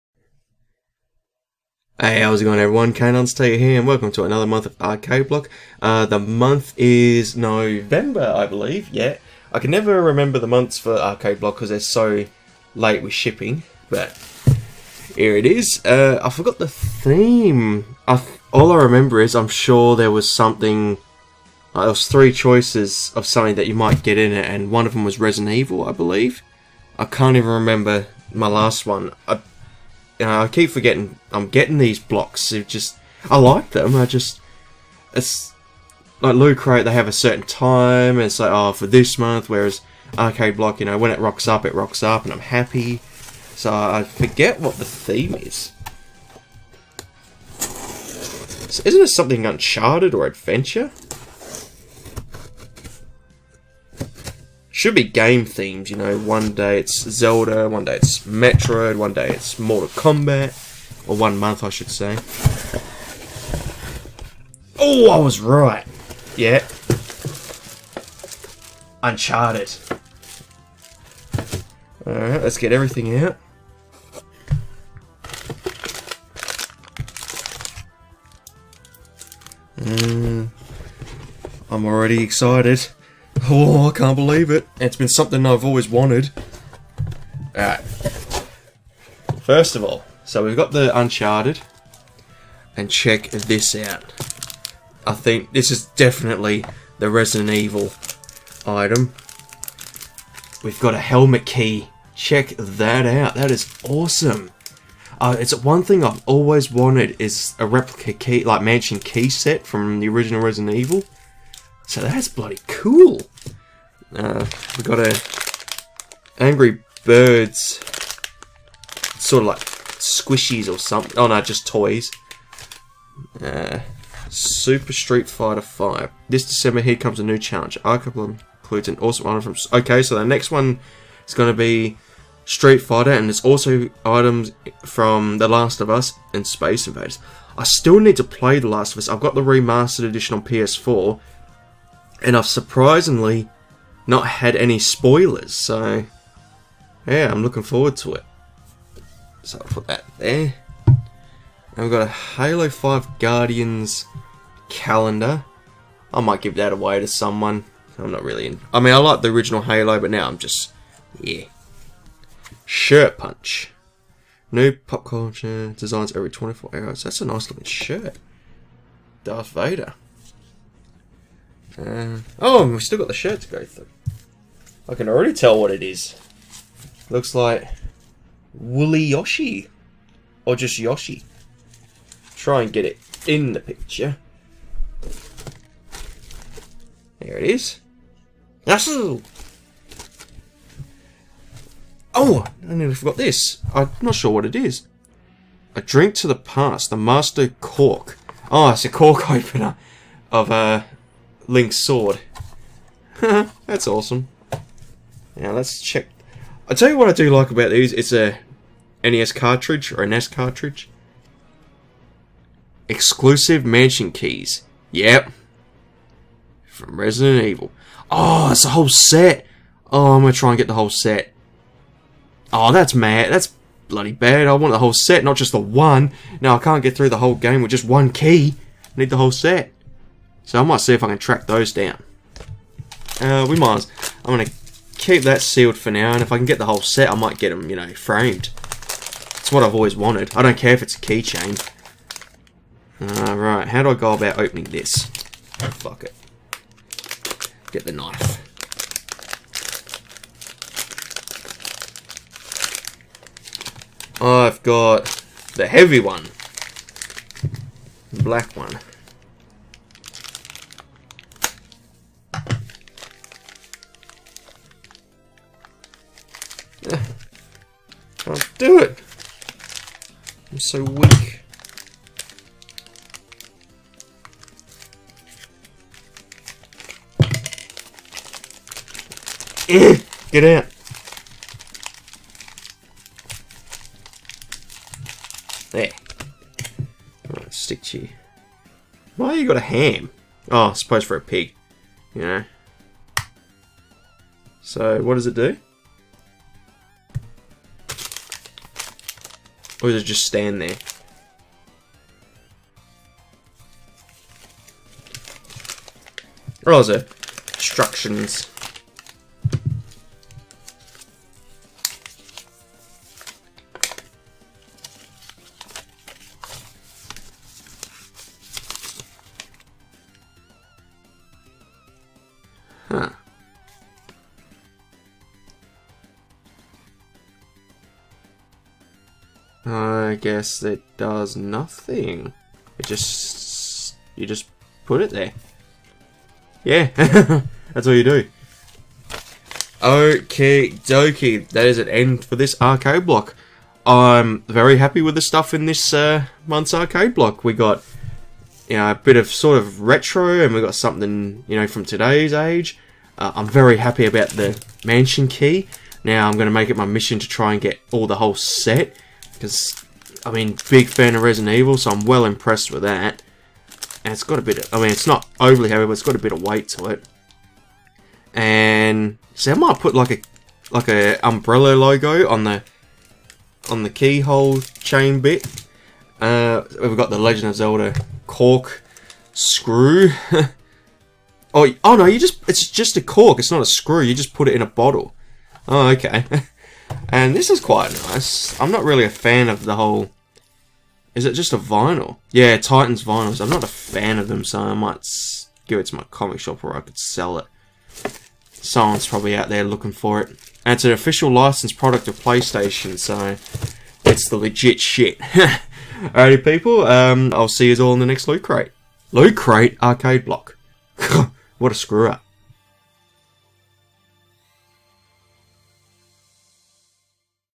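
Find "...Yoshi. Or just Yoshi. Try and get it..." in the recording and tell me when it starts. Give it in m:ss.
2:59.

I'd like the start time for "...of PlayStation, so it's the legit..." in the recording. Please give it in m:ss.
6:42.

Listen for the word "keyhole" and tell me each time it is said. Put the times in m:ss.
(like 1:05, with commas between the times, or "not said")
6:13.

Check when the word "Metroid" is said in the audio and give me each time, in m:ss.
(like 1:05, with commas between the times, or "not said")
0:58.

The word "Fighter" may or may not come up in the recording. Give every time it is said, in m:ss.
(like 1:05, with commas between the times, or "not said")
2:05, 2:12.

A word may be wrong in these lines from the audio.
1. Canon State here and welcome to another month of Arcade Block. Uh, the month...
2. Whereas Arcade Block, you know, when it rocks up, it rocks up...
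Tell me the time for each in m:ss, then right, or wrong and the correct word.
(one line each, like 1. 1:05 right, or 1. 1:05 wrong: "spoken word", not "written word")
1. 0:02 right
2. 0:39 right.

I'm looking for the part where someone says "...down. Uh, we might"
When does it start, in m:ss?
3:51.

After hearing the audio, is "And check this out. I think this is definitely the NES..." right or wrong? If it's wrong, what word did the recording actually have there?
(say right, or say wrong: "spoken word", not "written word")
wrong: "Resident", not "NES".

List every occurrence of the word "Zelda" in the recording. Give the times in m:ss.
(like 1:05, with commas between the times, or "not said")
0:57, 6:17.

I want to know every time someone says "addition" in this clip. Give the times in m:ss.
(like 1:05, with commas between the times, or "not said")
not said.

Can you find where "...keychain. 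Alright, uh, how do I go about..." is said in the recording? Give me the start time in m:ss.
4:00.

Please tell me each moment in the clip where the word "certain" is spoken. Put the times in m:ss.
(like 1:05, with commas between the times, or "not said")
0:37.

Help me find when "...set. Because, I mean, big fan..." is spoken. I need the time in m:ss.
5:58.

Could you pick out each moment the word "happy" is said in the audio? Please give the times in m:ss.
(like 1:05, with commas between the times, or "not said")
0:42, 5:44, 5:53.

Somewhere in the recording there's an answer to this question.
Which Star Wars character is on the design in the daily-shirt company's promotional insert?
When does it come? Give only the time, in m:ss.
2:49.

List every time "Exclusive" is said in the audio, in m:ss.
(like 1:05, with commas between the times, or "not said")
3:32.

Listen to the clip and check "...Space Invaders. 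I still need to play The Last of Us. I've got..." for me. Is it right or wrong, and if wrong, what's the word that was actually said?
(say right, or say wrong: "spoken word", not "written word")
right.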